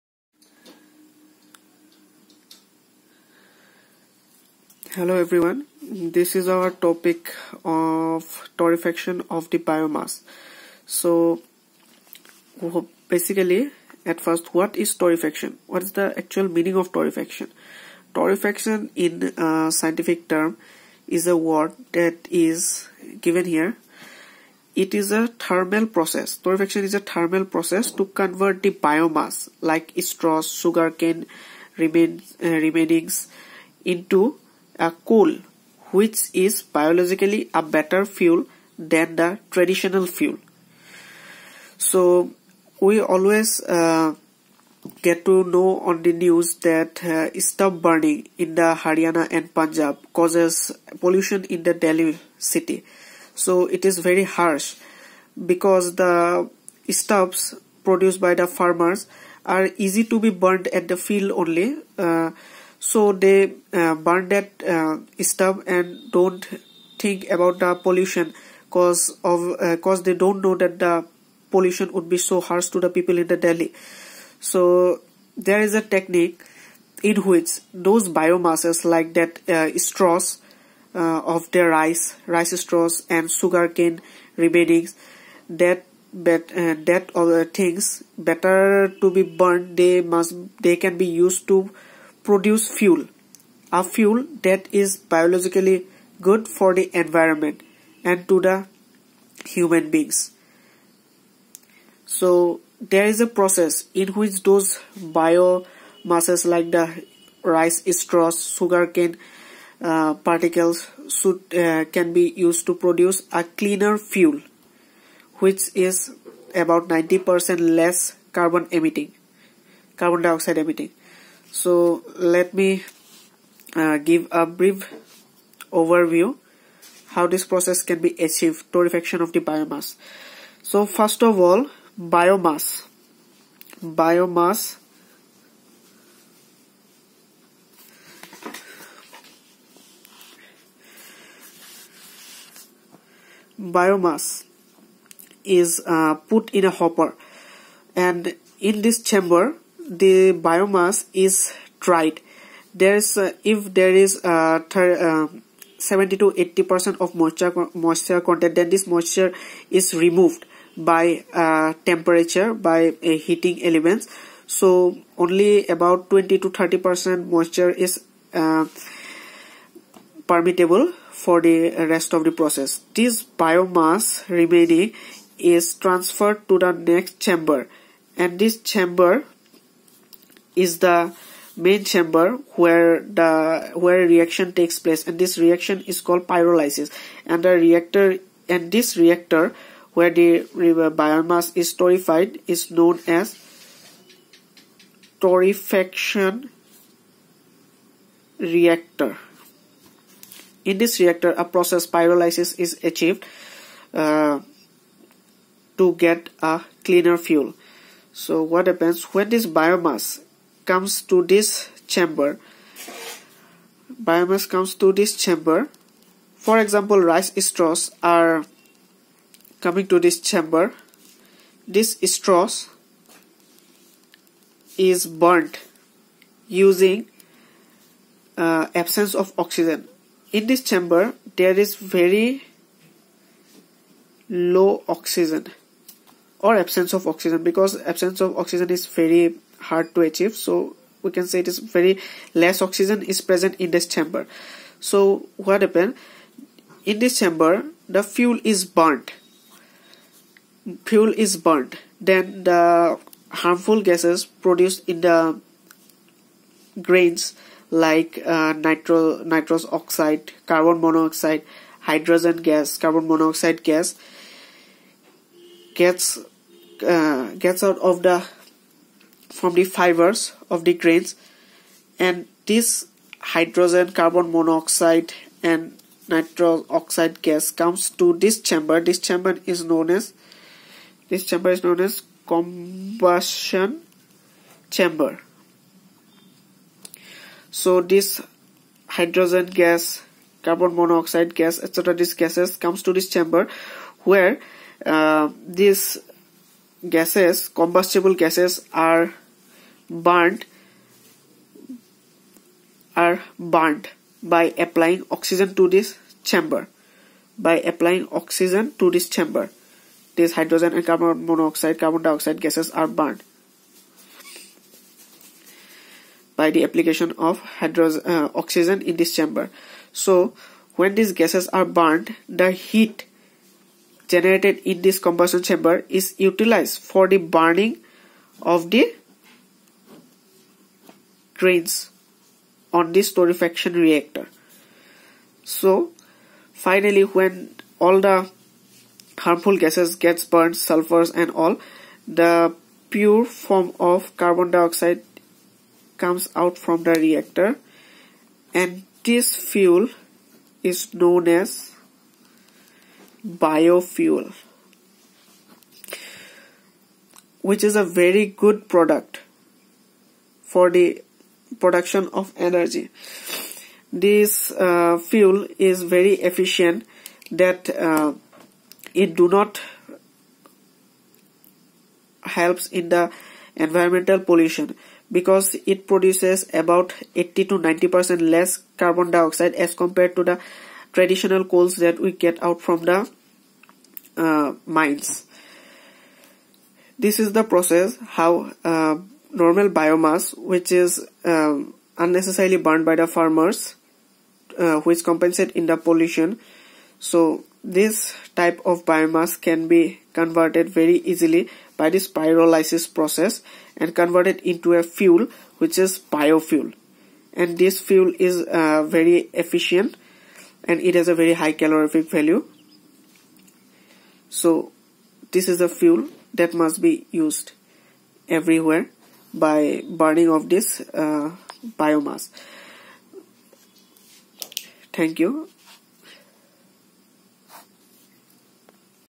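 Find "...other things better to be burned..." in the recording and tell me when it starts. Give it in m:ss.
1:27.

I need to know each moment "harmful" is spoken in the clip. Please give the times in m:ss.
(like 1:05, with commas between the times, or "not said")
4:13, 5:39.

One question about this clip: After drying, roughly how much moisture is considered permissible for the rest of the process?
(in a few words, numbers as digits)
20 to 30 percent.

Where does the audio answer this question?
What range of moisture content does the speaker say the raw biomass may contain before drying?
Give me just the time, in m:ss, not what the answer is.
2:35.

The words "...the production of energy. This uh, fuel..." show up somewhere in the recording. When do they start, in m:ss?
6:00.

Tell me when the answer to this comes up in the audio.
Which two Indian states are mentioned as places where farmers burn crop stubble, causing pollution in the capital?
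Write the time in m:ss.
0:48.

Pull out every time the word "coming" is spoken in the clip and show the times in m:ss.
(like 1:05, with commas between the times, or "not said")
3:39.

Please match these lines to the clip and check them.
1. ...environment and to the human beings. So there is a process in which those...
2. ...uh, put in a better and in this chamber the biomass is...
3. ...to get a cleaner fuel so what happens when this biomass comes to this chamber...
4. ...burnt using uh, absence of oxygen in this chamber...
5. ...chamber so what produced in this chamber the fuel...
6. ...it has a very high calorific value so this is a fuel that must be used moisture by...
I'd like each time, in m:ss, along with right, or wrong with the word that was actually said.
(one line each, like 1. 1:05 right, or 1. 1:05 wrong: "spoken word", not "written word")
1. 1:36 right
2. 2:25 wrong: "hopper", not "better"
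3. 3:25 right
4. 3:45 right
5. 4:03 wrong: "happened", not "produced"
6. 6:50 wrong: "everywhere", not "moisture".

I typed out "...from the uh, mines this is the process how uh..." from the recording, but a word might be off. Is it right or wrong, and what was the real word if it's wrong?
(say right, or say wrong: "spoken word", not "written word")
right.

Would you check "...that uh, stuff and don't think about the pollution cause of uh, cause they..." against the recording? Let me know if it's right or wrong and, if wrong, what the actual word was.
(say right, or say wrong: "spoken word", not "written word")
right.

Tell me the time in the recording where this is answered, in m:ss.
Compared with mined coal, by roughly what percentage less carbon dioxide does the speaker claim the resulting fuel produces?
6:17.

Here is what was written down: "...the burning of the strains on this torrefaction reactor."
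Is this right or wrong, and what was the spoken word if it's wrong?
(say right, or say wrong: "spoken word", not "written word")
right.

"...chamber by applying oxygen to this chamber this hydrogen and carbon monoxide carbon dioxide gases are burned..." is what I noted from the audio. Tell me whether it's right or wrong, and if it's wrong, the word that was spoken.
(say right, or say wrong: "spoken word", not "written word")
right.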